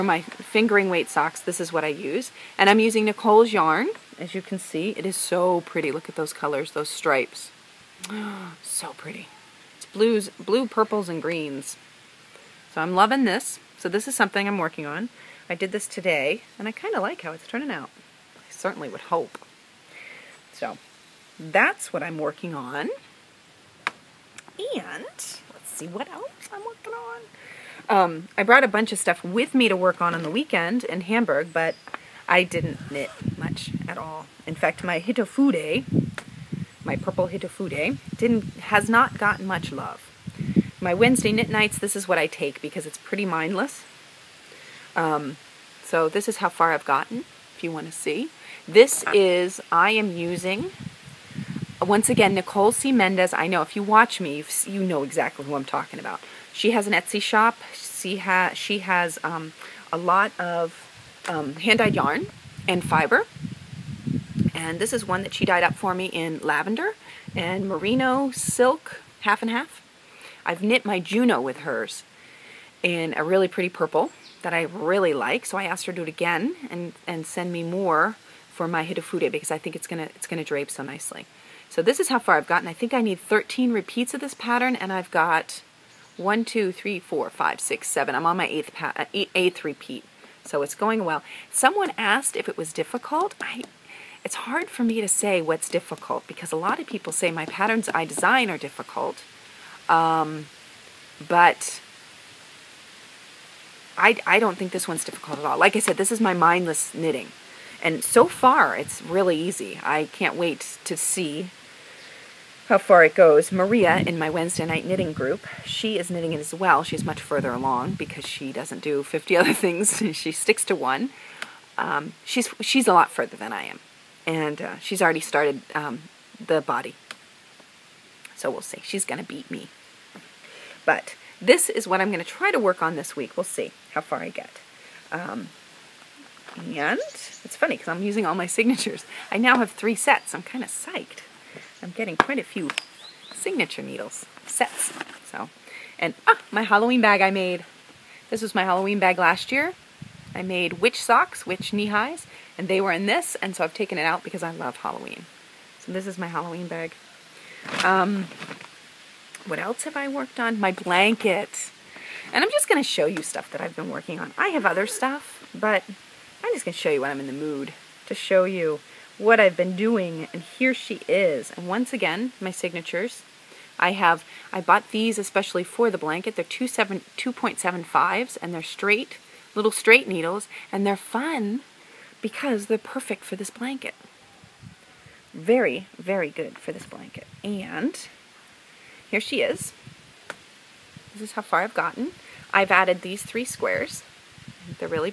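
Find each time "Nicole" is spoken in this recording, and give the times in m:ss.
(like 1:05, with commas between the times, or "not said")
0:03, 0:52.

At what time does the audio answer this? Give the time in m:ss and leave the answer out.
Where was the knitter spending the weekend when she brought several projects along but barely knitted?
0:31.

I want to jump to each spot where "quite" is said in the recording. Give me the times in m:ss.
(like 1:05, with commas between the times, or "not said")
2:22.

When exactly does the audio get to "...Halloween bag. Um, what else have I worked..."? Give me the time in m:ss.
2:36.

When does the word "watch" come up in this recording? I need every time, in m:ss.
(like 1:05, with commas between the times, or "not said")
0:53.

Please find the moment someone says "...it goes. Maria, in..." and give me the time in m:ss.
1:53.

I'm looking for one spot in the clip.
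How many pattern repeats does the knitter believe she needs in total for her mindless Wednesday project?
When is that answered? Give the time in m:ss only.
1:23.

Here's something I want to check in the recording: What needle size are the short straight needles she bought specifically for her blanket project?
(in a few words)
2.75.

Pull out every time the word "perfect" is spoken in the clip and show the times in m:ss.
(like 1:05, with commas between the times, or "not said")
3:02.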